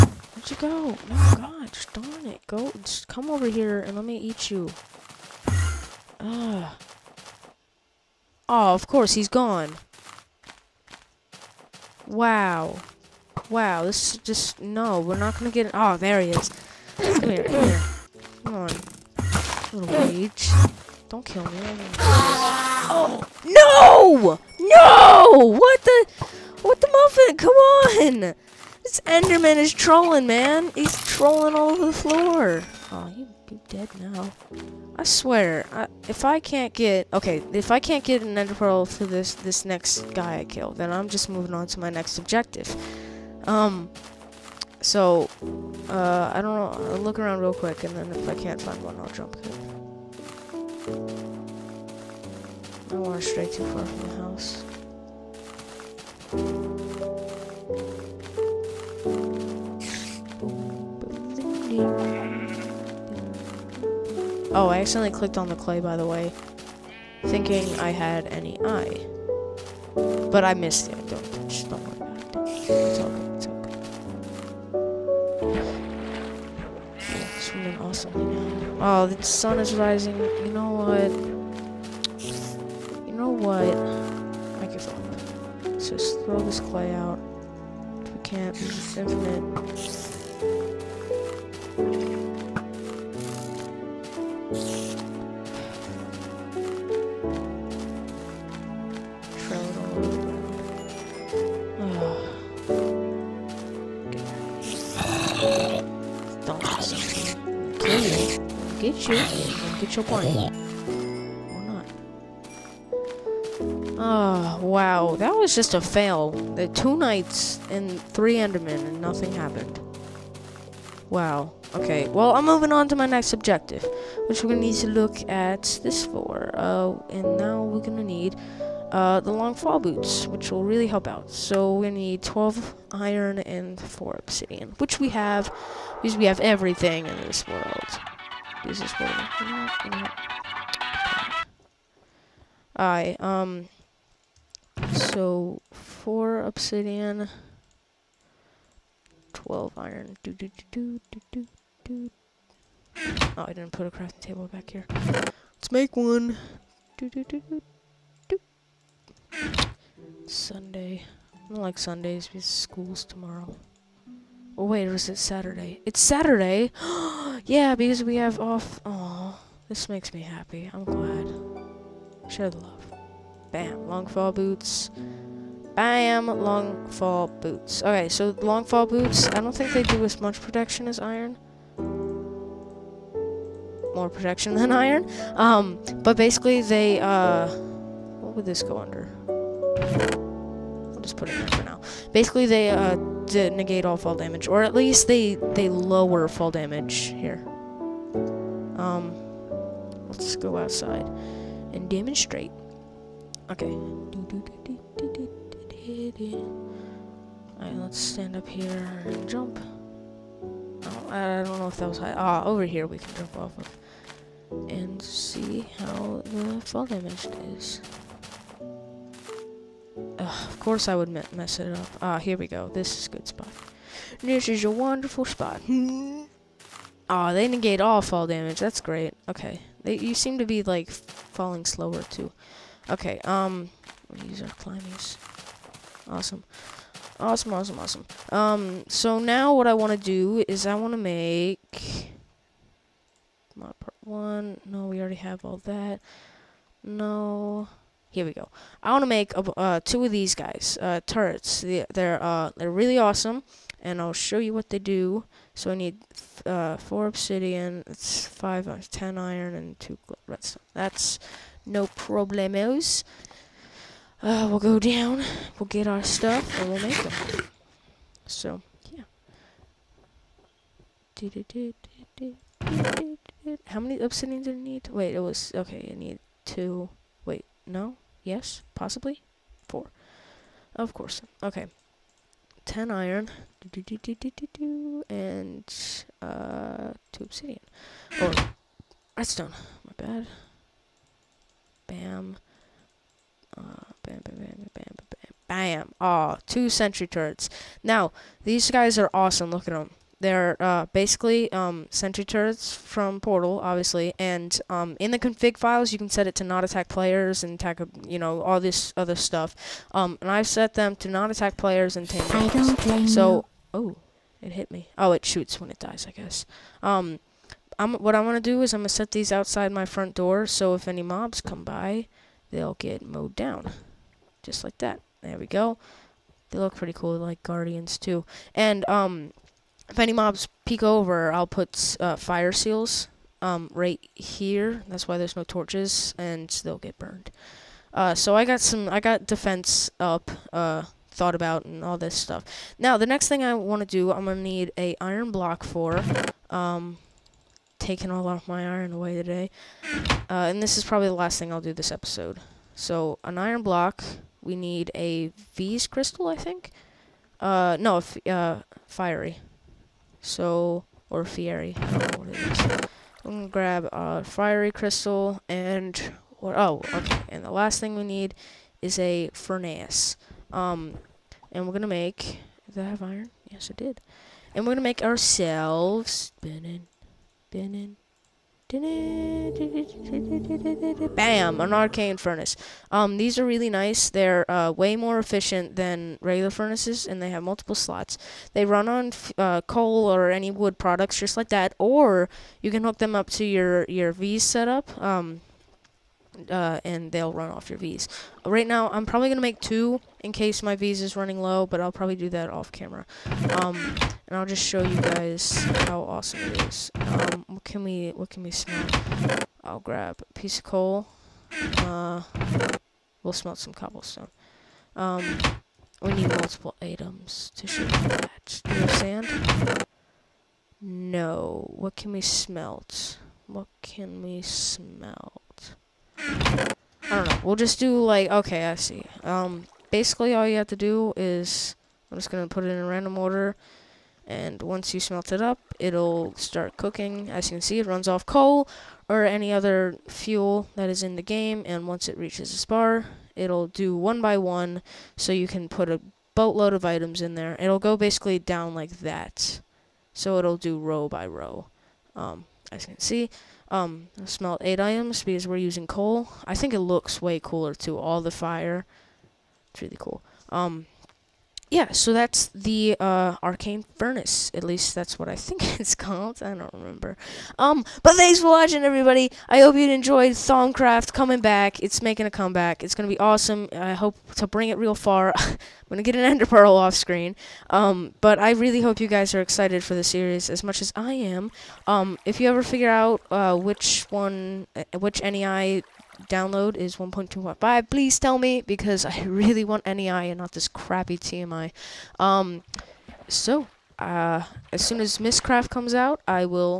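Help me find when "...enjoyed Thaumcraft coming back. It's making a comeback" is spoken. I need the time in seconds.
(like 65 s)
469 s.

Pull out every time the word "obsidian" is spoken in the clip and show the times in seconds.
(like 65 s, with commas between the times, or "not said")
134 s, 146 s, 257 s, 274 s, 287 s.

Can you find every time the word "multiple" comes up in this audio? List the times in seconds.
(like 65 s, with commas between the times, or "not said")
387 s, 416 s.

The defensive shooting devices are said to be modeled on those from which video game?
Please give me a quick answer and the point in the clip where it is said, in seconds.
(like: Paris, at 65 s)
Portal, at 303 s.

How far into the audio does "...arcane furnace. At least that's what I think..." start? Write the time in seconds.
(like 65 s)
463 s.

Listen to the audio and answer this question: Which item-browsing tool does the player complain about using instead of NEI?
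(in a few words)
TMI.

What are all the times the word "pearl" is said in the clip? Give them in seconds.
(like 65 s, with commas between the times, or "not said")
38 s, 476 s.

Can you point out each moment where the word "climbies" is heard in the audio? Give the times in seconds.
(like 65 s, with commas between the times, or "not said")
234 s.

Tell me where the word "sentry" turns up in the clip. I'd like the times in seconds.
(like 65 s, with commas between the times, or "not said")
296 s, 301 s.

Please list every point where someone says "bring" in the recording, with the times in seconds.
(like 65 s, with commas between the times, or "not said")
474 s.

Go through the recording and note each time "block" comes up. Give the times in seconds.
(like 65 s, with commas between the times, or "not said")
345 s, 353 s.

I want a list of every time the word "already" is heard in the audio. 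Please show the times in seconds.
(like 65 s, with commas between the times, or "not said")
245 s.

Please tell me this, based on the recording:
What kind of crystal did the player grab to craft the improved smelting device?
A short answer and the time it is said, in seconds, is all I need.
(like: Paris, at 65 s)
Fiery crystal, at 364 s.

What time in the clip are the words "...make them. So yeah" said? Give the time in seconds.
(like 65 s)
266 s.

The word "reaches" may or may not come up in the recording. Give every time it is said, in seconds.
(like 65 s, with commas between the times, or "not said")
442 s.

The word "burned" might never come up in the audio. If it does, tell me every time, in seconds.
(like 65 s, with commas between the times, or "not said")
336 s.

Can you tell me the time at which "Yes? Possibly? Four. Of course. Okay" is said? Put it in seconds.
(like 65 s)
278 s.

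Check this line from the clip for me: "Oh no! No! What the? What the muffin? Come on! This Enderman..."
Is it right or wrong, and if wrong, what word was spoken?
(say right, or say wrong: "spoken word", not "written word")
right.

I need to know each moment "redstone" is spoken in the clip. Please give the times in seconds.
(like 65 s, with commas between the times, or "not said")
260 s, 289 s.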